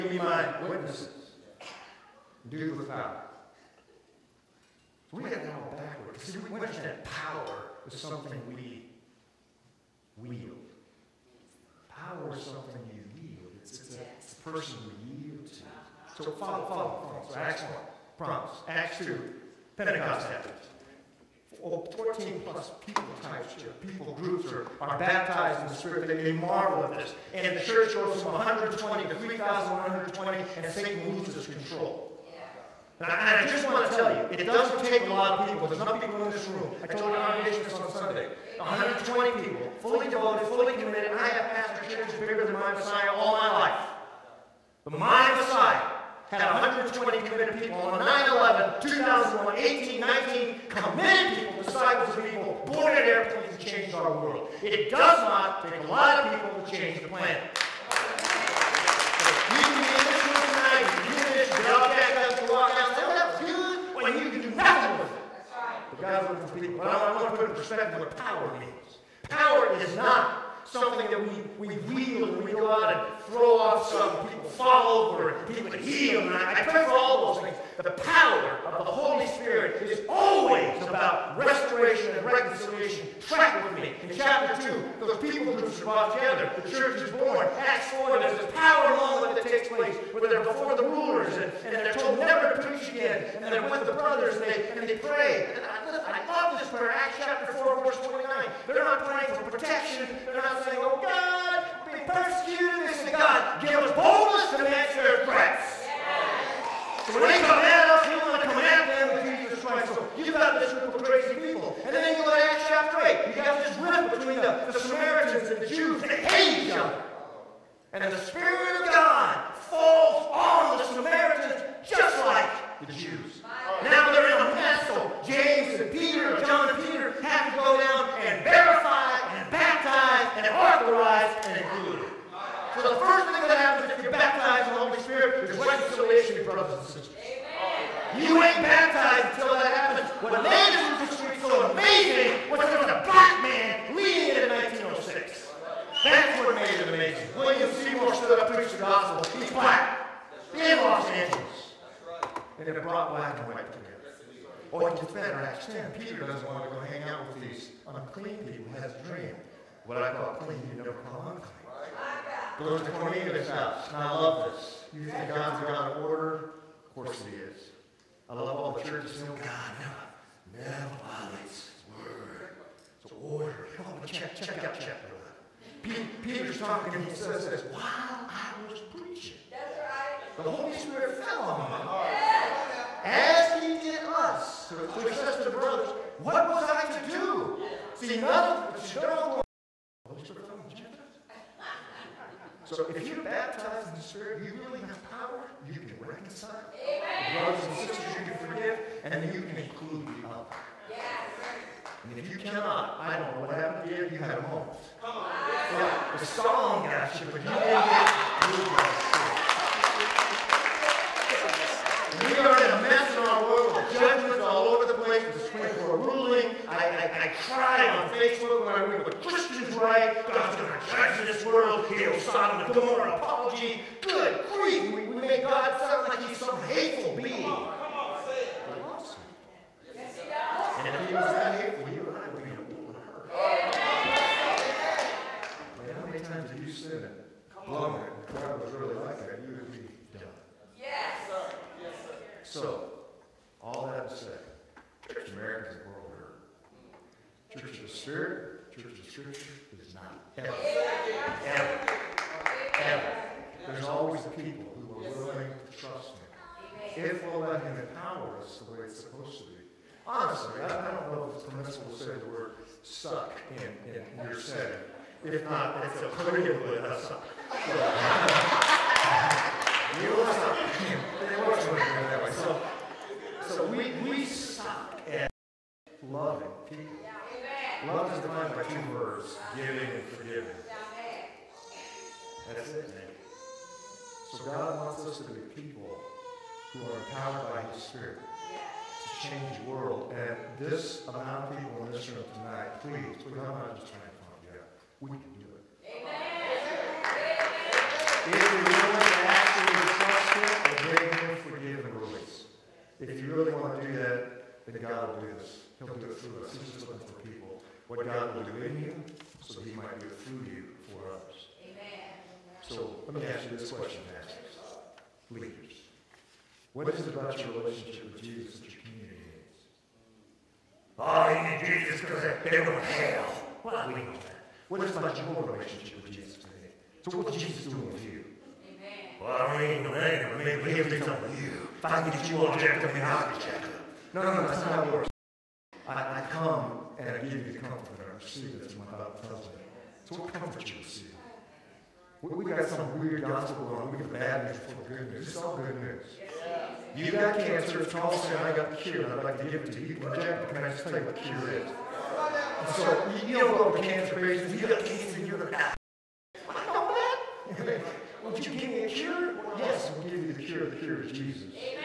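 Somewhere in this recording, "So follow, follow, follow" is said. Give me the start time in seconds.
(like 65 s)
16 s.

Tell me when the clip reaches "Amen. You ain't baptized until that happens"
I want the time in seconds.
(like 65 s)
137 s.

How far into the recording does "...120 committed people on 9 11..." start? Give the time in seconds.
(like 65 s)
46 s.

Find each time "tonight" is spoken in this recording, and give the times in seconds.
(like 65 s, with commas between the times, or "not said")
60 s.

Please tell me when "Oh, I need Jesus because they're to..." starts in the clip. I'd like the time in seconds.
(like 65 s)
320 s.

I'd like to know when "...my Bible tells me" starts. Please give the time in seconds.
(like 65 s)
338 s.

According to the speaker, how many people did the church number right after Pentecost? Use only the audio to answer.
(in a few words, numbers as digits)
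3,120.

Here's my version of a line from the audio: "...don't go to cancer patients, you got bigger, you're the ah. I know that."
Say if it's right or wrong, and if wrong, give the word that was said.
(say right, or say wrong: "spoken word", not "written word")
wrong: "cancer", not "bigger".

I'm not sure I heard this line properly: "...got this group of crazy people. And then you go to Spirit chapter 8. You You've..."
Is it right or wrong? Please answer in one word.
wrong.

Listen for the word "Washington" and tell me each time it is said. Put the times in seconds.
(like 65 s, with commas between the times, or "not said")
not said.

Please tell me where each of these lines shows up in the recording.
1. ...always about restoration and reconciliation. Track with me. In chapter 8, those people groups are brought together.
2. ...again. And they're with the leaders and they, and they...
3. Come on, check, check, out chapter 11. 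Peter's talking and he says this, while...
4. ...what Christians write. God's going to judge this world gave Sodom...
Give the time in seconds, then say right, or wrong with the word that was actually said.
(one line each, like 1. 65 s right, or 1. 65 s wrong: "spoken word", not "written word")
1. 80 s wrong: "2", not "8"
2. 92 s wrong: "brothers", not "leaders"
3. 173 s right
4. 219 s right.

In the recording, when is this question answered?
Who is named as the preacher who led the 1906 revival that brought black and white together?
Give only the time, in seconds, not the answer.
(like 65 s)
147 s.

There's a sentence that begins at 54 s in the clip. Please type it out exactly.
It does not take a lot of people to change the planet.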